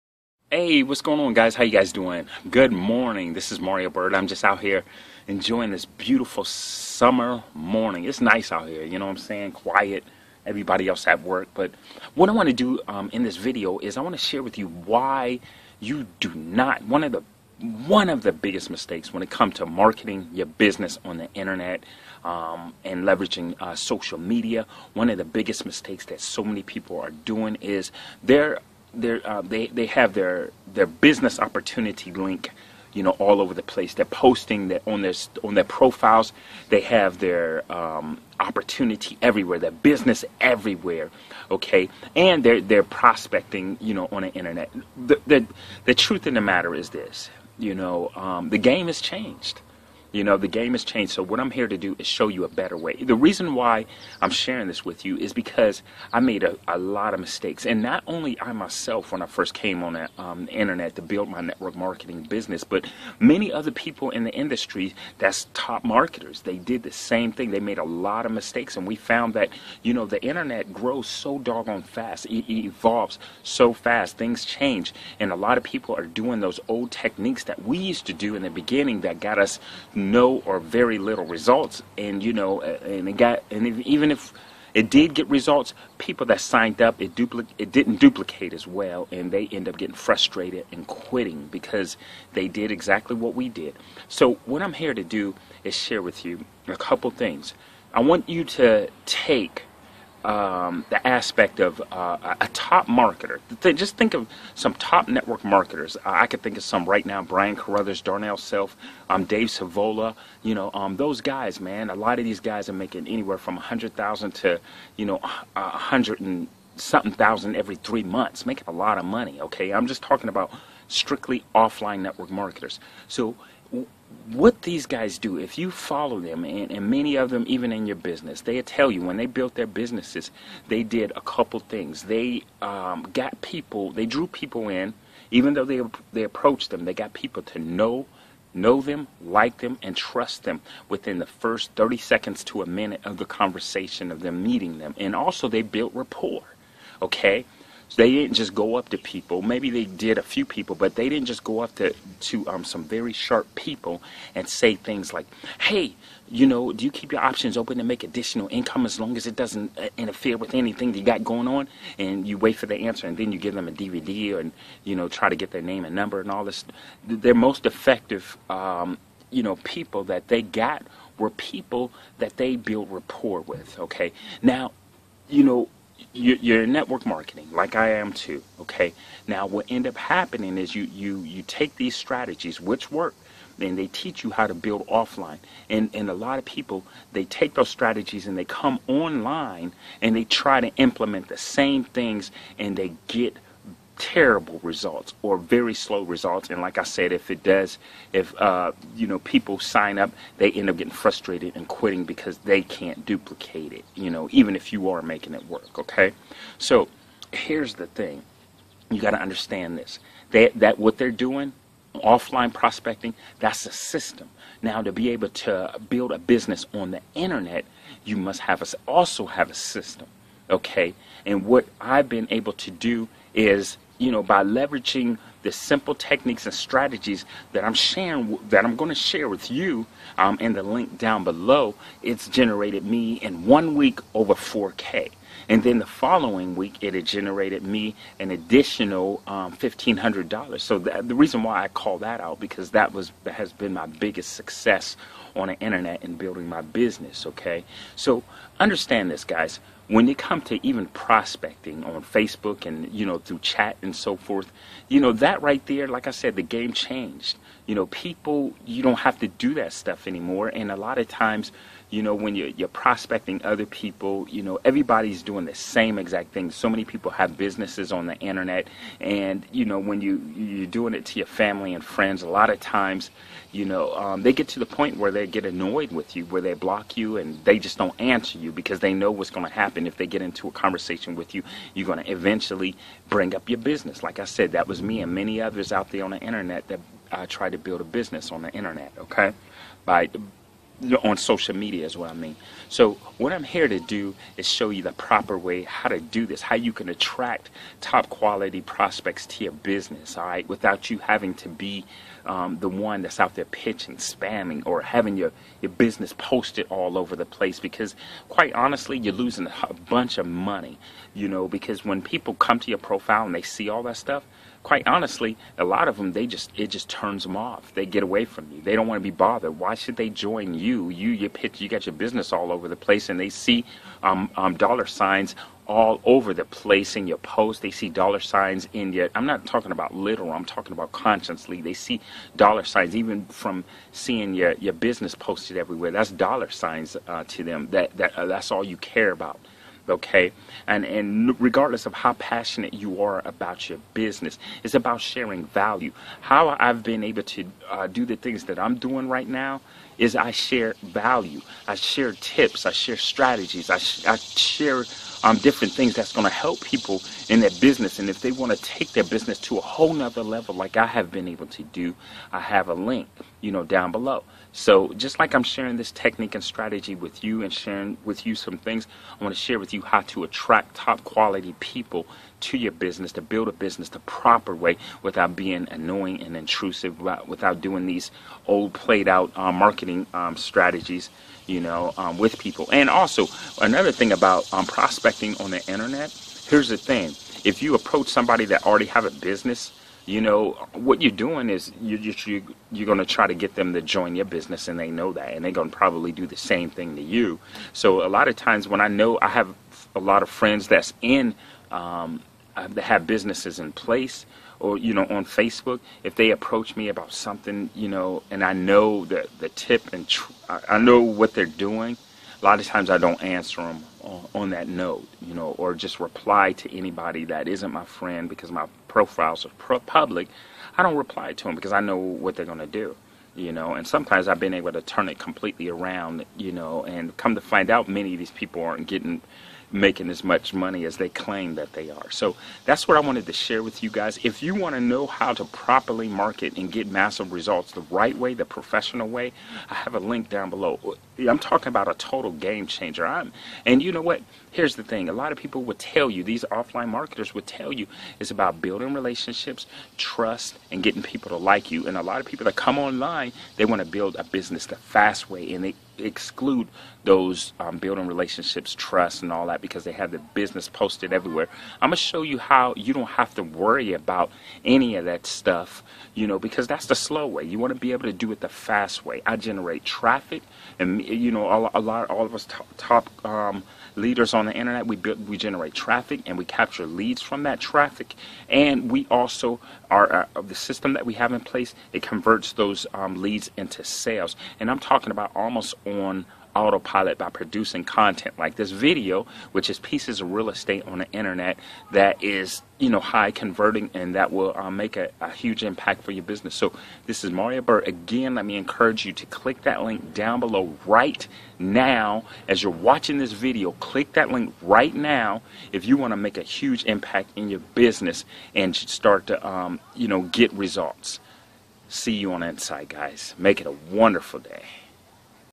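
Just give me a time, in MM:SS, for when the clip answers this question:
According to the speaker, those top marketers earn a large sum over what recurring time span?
01:57.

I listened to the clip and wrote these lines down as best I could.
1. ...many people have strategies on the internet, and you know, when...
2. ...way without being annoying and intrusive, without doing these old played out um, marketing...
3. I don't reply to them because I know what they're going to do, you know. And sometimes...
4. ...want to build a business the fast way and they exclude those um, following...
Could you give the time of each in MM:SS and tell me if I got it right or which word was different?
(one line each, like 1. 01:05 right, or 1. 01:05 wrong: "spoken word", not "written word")
1. 04:26 wrong: "businesses", not "strategies"
2. 06:14 right
3. 07:00 right
4. 07:33 wrong: "building", not "following".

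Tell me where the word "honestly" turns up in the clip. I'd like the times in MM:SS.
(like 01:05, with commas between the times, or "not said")
05:08, 05:14.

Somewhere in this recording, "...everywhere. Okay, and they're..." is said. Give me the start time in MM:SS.
00:40.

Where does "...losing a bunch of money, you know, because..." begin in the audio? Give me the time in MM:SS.
05:09.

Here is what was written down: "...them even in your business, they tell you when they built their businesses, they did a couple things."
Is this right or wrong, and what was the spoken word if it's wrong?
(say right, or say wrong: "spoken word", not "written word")
right.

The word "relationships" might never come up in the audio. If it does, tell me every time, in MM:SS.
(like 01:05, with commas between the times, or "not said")
07:28, 07:38.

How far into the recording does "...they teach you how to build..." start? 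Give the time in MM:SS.
03:03.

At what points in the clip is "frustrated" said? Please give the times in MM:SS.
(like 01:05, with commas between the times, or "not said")
01:29, 03:20.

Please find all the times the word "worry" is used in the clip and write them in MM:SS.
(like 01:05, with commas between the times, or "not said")
07:43.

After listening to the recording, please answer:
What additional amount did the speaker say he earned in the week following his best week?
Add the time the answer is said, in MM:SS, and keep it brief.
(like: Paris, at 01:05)
$1,500, at 03:59.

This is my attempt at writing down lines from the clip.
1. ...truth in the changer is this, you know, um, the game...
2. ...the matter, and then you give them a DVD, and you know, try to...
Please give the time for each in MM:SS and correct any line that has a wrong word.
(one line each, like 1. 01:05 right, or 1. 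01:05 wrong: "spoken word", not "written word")
1. 00:45 wrong: "matter", not "changer"
2. 02:42 wrong: "answer", not "matter".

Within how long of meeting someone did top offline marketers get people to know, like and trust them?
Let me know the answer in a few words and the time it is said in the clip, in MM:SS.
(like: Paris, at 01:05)
30 seconds to a minute, at 02:21.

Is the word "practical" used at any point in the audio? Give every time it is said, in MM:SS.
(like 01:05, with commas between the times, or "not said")
not said.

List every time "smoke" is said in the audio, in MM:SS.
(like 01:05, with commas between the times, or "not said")
not said.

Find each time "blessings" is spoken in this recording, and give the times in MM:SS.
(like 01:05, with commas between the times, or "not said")
not said.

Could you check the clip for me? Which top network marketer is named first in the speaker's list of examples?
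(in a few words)
Brian Carruthers.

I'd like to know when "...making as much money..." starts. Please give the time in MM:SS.
07:09.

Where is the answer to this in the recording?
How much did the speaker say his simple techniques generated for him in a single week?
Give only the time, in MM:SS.
03:54.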